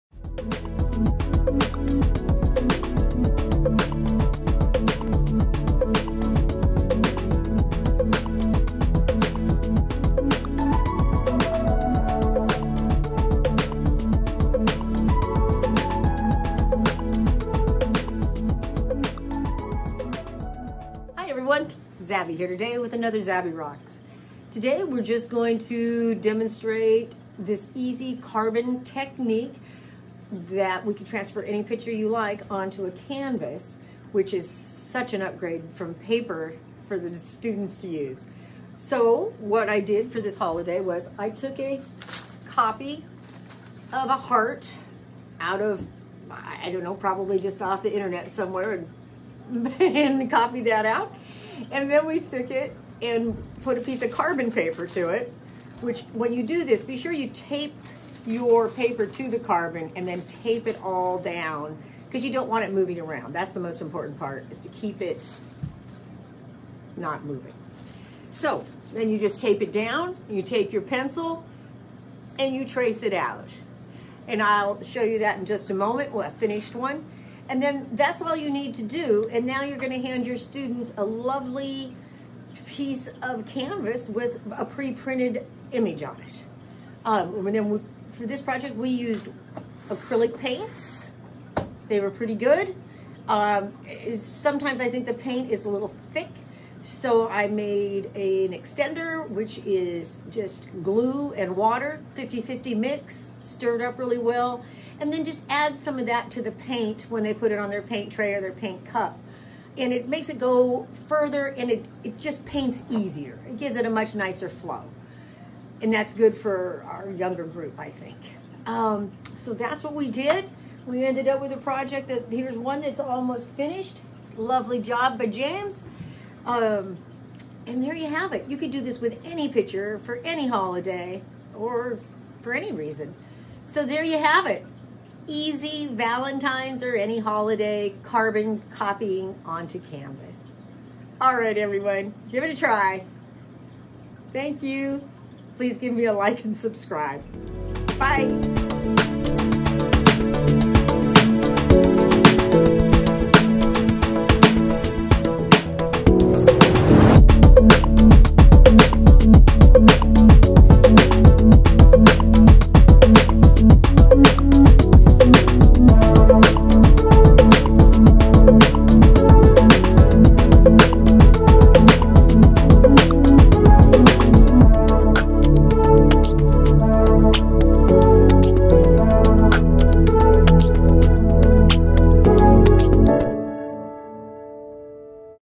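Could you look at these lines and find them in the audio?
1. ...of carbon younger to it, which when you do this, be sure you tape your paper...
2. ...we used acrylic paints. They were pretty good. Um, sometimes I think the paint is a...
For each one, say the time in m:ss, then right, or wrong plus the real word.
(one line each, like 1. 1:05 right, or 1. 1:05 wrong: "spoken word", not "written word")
1. 0:54 wrong: "paper", not "younger"
2. 1:28 right.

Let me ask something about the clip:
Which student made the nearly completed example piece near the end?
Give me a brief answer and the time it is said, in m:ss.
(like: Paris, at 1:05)
James, at 2:05.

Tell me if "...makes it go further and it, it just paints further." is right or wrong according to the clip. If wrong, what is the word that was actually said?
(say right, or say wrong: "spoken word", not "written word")
wrong: "easier", not "further".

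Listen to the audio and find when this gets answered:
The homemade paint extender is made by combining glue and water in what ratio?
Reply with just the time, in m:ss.
1:42.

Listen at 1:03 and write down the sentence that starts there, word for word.
That's the most important part is to keep it not moving.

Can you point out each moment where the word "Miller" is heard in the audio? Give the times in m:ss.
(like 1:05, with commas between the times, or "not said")
not said.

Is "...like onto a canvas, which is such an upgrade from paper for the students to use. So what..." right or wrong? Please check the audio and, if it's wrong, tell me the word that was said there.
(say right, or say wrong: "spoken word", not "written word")
right.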